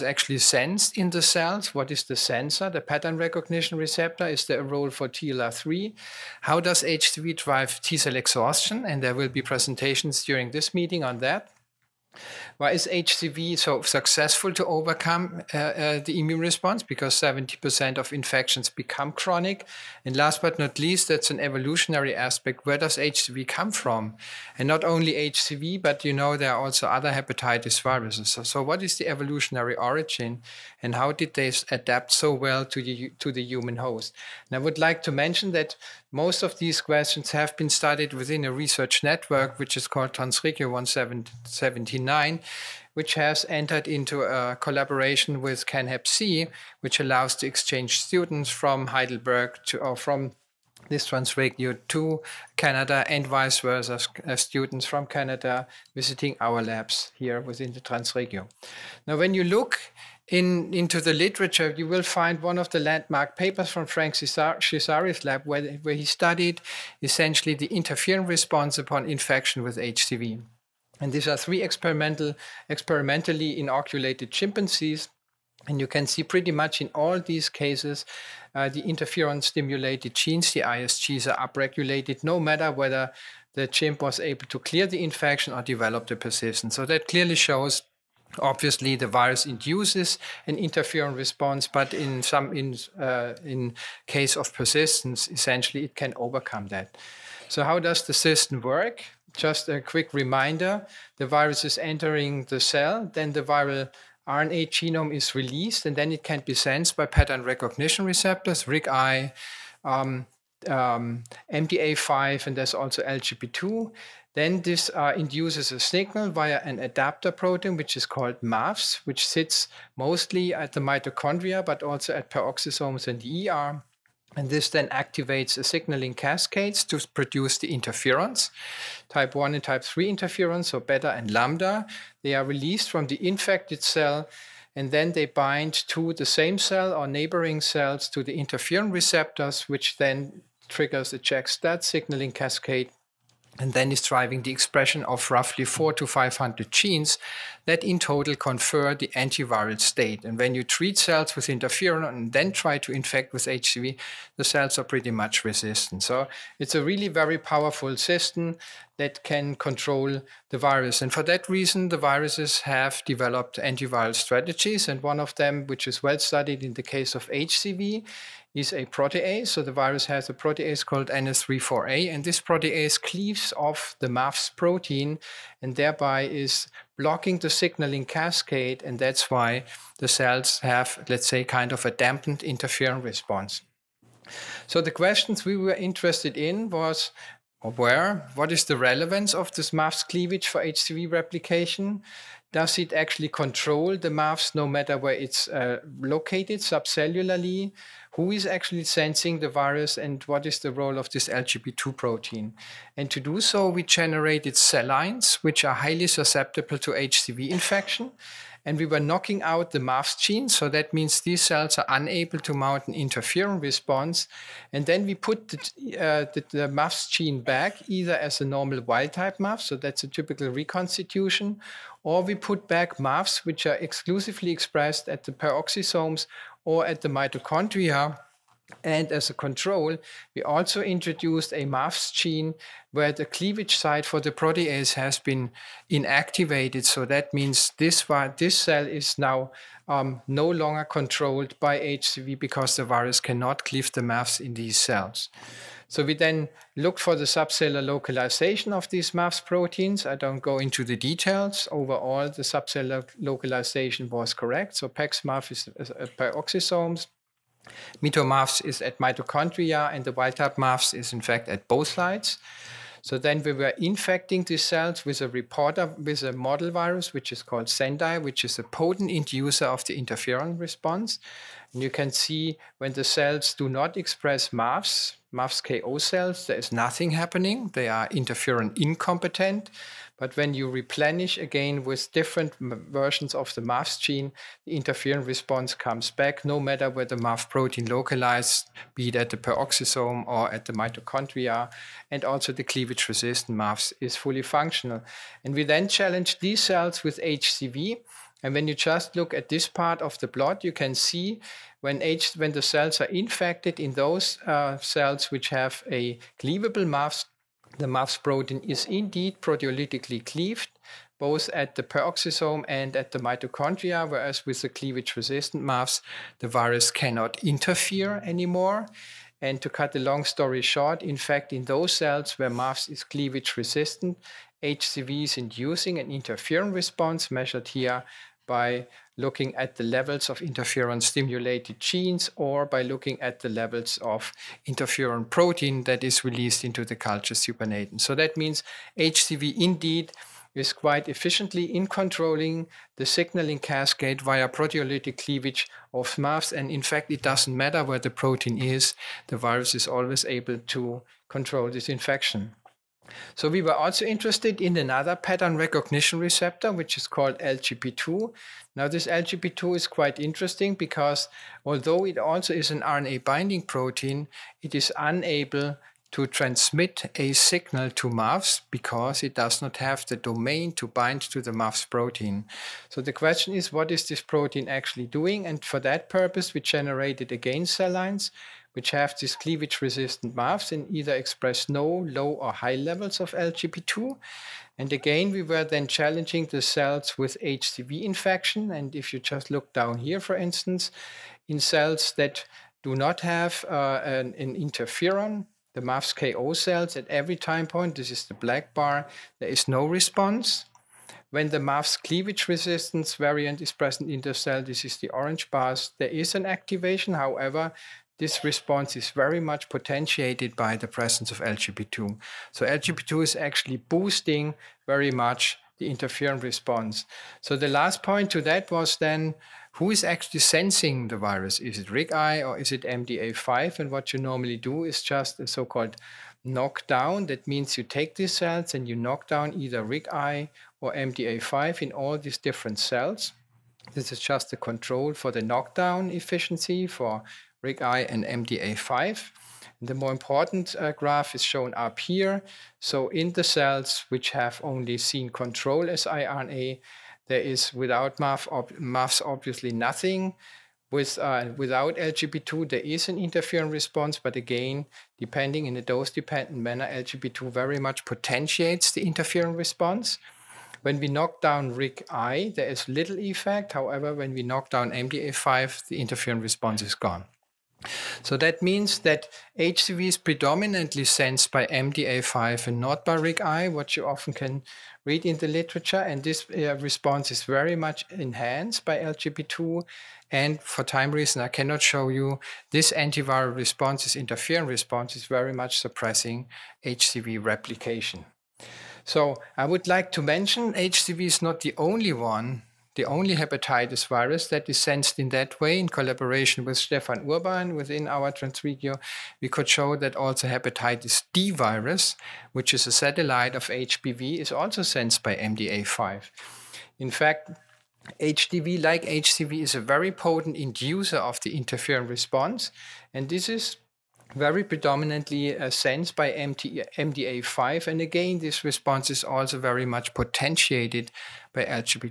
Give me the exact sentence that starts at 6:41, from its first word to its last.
When the MAF's cleavage resistance variant is present in the cell, this is the orange bars, there is an activation.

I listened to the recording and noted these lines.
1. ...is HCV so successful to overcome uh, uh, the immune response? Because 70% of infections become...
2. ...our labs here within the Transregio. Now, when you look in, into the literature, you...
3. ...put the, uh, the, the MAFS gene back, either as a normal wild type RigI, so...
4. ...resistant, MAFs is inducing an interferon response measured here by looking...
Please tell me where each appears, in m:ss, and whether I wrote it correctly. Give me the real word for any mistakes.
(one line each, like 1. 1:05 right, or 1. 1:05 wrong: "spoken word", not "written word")
1. 0:12 right
2. 0:56 right
3. 3:35 wrong: "MAFS", not "RigI"
4. 5:23 wrong: "HCV", not "MAFs".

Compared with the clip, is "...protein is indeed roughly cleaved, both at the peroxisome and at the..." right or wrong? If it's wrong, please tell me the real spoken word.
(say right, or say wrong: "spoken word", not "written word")
wrong: "proteolytically", not "roughly".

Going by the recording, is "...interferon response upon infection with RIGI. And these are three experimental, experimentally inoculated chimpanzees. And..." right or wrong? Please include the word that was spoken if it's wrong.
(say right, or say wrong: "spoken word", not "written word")
wrong: "HCV", not "RIGI".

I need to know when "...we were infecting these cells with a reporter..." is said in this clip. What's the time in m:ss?
4:23.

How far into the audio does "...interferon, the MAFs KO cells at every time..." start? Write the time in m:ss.
6:34.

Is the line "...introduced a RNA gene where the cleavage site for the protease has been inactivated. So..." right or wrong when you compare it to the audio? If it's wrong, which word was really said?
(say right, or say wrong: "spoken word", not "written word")
wrong: "MAFS", not "RNA".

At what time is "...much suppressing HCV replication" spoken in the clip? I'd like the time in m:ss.
8:05.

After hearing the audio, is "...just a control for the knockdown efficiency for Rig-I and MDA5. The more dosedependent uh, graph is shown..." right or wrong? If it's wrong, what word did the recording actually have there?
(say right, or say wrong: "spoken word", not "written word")
wrong: "important", not "dosedependent".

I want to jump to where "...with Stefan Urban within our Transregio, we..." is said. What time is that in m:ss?
8:16.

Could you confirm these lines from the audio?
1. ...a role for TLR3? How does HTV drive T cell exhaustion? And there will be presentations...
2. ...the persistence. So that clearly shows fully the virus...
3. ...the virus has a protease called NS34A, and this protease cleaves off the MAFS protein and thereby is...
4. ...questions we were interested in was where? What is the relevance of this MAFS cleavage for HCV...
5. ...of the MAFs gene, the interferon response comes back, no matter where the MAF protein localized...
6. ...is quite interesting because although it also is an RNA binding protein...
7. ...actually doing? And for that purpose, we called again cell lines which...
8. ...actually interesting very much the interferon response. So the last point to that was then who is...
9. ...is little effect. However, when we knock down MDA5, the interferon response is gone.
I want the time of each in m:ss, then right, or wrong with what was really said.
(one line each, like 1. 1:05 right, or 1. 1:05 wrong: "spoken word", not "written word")
1. 0:04 right
2. 1:26 wrong: "obviously", not "fully"
3. 2:49 right
4. 3:04 right
5. 4:43 right
6. 5:59 right
7. 6:14 wrong: "generated", not "called"
8. 6:53 wrong: "boosting", not "interesting"
9. 7:42 right.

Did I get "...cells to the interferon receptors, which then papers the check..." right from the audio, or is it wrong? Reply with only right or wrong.
wrong.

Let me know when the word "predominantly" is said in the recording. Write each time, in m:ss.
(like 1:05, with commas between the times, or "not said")
7:50, 8:34.